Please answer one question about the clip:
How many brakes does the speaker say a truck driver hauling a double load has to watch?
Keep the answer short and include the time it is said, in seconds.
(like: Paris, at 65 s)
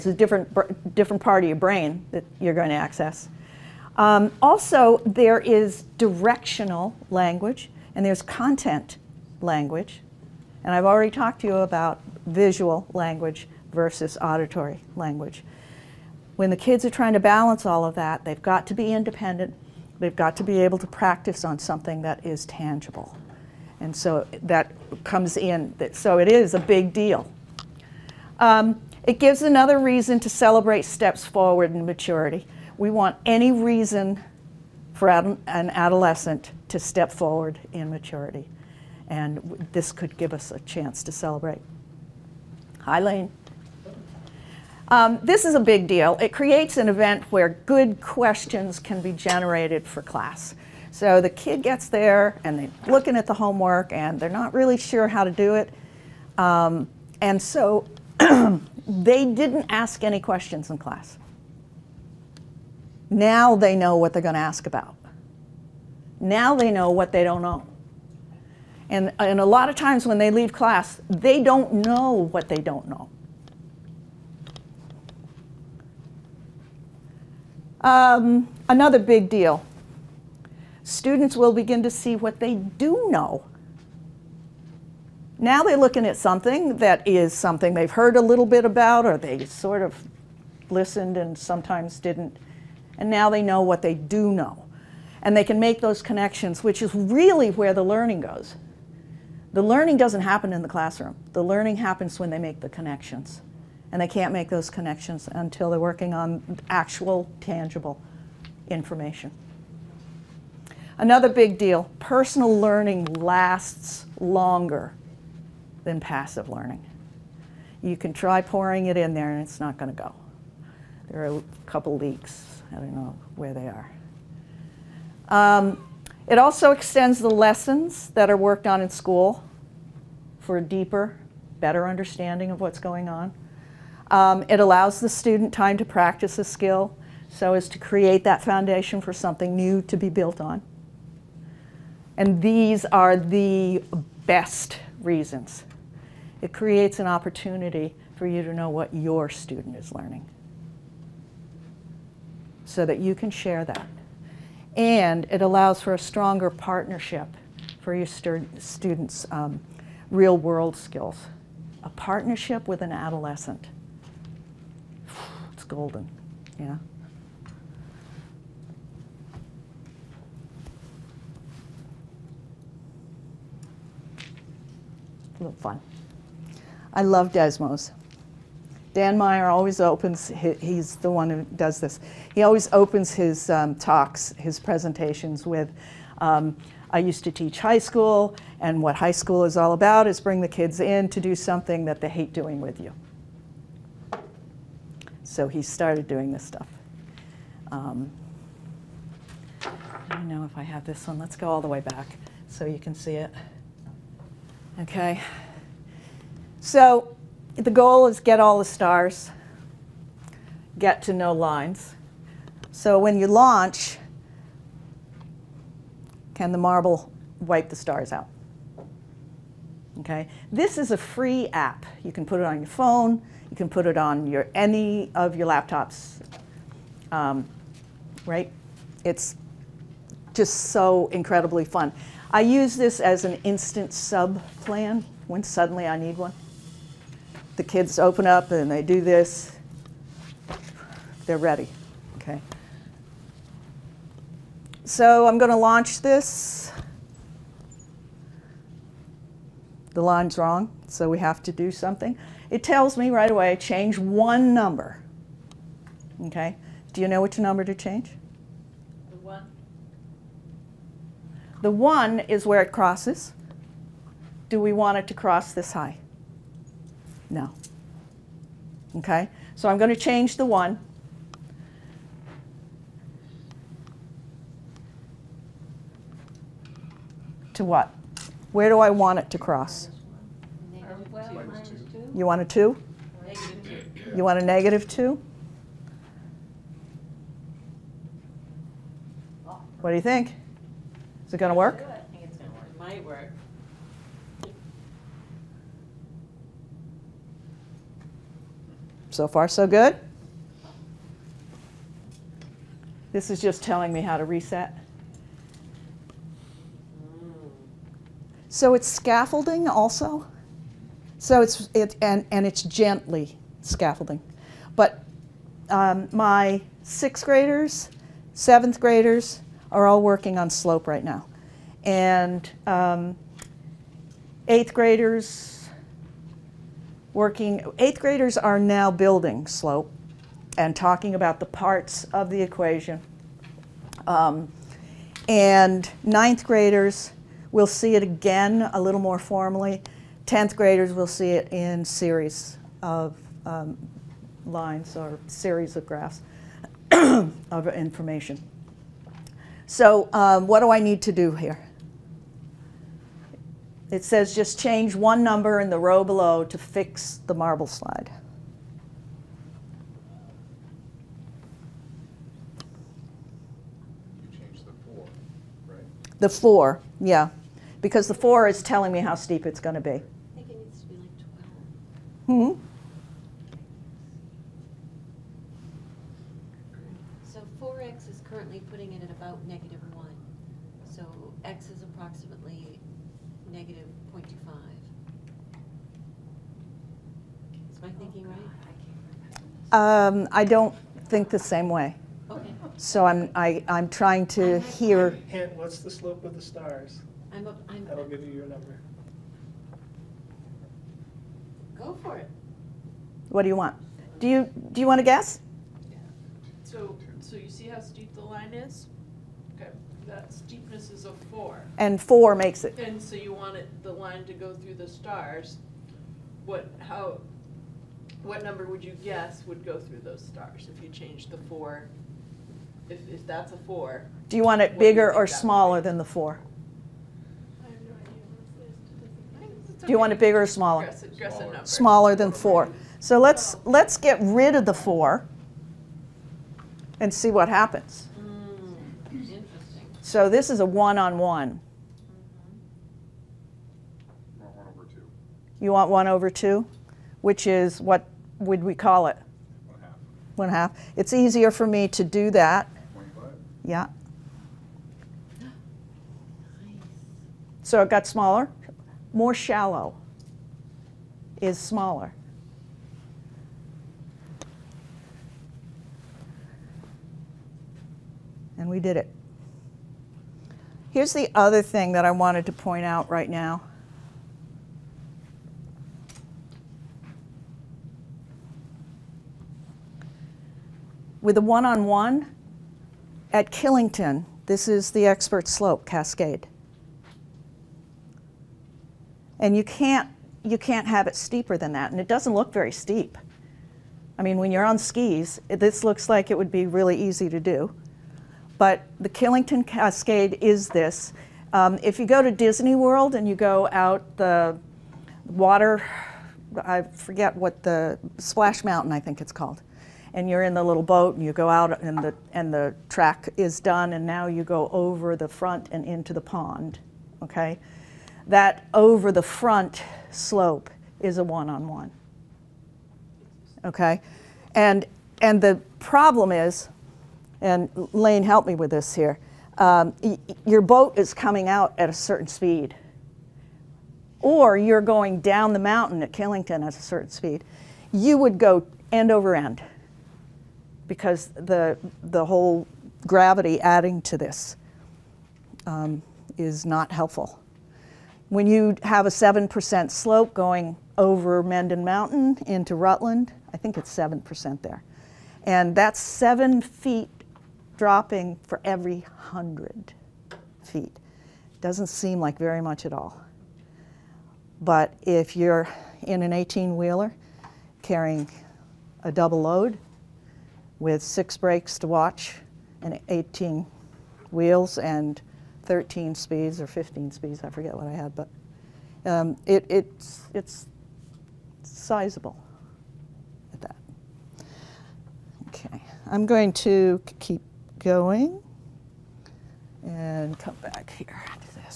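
6, at 571 s.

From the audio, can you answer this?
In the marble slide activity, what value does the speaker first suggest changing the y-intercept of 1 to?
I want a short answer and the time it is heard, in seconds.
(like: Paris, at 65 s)
-2, at 284 s.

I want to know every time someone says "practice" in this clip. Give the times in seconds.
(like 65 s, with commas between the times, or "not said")
20 s, 135 s.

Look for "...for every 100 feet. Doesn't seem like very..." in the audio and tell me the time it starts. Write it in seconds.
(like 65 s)
558 s.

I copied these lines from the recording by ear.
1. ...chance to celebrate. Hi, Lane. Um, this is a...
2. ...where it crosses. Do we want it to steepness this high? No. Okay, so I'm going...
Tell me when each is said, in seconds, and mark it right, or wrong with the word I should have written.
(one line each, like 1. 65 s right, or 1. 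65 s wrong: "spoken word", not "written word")
1. 40 s right
2. 262 s wrong: "cross", not "steepness".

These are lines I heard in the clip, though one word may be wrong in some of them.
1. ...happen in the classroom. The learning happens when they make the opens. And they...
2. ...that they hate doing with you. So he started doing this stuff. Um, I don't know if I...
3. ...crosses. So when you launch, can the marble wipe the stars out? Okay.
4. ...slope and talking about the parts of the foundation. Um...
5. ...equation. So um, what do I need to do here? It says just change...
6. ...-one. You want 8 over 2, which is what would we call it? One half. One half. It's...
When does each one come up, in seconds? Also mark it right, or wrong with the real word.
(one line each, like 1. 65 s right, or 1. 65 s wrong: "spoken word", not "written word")
1. 100 s wrong: "connections", not "opens"
2. 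191 s right
3. 211 s wrong: "lines", not "crosses"
4. 329 s wrong: "equation", not "foundation"
5. 347 s wrong: "information", not "equation"
6. 444 s wrong: "1", not "8".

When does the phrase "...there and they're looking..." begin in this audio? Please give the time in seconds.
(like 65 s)
51 s.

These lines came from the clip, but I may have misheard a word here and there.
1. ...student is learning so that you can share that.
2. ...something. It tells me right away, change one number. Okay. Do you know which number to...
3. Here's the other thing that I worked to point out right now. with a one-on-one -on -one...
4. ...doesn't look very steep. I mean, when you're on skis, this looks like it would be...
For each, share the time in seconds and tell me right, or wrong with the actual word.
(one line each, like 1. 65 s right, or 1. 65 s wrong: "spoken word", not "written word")
1. 149 s right
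2. 251 s right
3. 470 s wrong: "wanted", not "worked"
4. 492 s right.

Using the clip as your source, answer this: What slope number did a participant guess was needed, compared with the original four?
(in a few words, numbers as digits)
12.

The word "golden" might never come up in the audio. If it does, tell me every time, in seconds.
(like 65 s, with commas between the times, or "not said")
165 s.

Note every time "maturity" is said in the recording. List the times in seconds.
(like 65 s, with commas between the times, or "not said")
31 s, 37 s.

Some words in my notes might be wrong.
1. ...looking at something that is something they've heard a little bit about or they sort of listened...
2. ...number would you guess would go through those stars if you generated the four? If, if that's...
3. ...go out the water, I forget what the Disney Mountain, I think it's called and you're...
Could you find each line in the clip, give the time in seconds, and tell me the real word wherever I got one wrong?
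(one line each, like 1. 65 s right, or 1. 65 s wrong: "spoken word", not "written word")
1. 85 s right
2. 418 s wrong: "changed", not "generated"
3. 503 s wrong: "Splash", not "Disney".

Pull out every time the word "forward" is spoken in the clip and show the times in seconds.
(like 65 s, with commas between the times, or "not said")
31 s, 37 s.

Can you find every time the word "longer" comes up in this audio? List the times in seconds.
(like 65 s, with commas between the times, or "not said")
114 s.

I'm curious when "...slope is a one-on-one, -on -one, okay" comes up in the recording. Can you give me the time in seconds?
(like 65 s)
520 s.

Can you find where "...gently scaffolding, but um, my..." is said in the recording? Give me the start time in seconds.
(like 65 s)
312 s.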